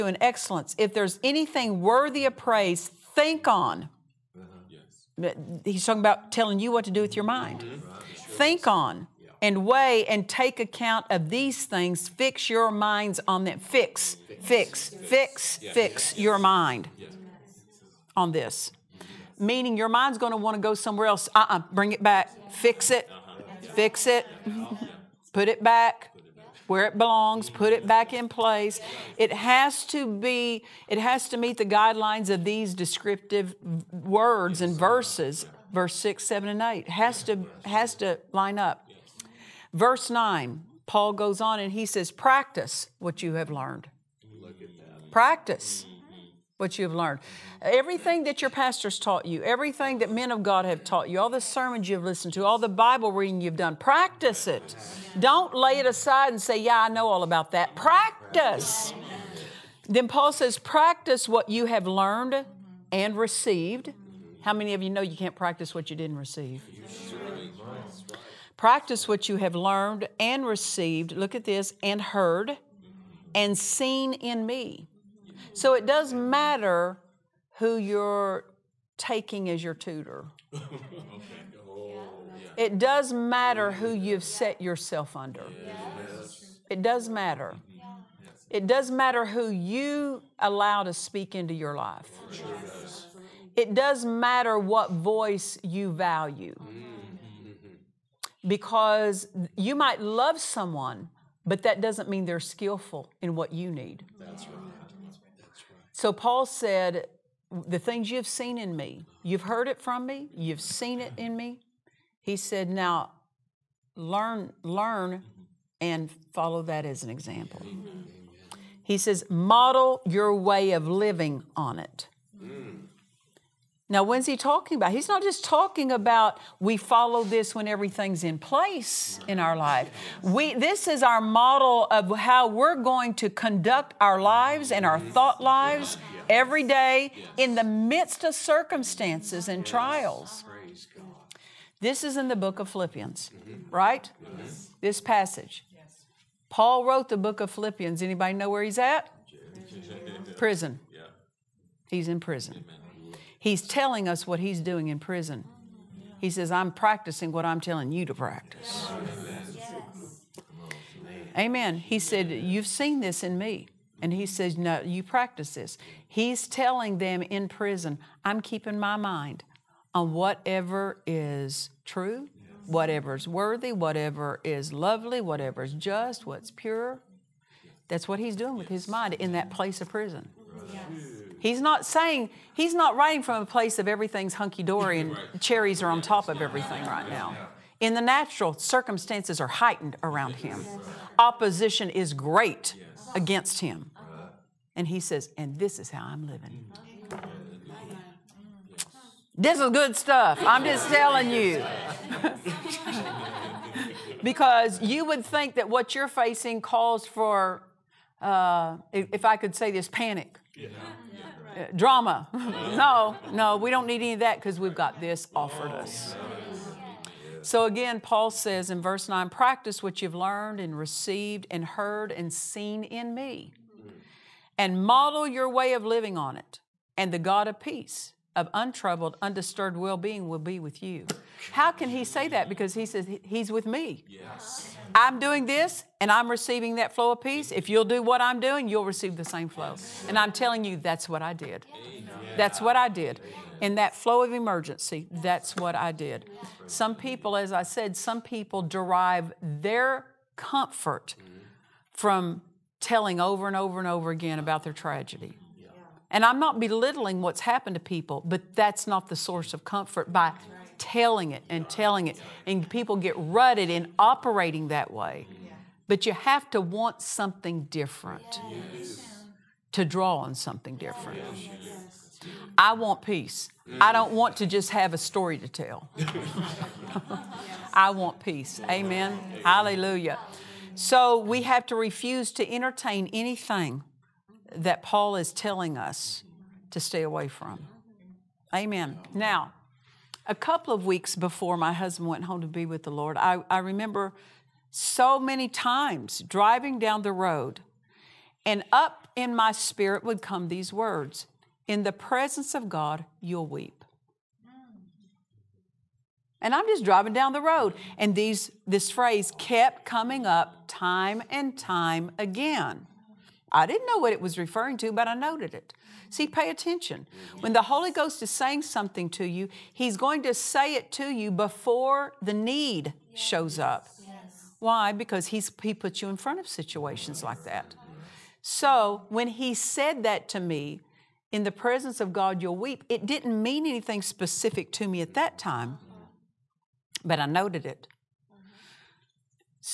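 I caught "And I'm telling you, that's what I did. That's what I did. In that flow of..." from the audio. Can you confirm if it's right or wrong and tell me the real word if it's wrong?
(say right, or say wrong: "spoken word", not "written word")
right.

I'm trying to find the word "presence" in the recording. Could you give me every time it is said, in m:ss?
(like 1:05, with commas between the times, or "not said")
5:01, 5:31.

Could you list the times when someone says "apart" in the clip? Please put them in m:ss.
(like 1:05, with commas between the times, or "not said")
not said.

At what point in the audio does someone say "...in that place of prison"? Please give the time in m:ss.
2:59.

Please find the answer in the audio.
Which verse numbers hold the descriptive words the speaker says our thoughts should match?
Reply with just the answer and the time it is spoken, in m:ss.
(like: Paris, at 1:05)
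6, 7, and 8, at 0:35.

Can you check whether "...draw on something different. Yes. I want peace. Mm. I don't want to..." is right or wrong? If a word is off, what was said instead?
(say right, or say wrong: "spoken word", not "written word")
right.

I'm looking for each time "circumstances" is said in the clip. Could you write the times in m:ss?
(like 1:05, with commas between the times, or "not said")
2:18, 3:08.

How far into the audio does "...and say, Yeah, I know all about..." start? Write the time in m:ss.
0:56.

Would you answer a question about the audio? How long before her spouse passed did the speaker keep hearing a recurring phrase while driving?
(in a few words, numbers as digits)
a couple of weeks.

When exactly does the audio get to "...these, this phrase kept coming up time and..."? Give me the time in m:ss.
5:08.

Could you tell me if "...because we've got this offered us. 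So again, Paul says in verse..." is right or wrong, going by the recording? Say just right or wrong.
right.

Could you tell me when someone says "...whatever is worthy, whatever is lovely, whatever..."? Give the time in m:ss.
2:52.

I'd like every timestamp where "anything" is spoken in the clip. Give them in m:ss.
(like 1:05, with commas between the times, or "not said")
0:01, 4:43, 5:33.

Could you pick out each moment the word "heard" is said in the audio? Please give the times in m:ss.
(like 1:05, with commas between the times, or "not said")
1:12, 1:49, 3:41.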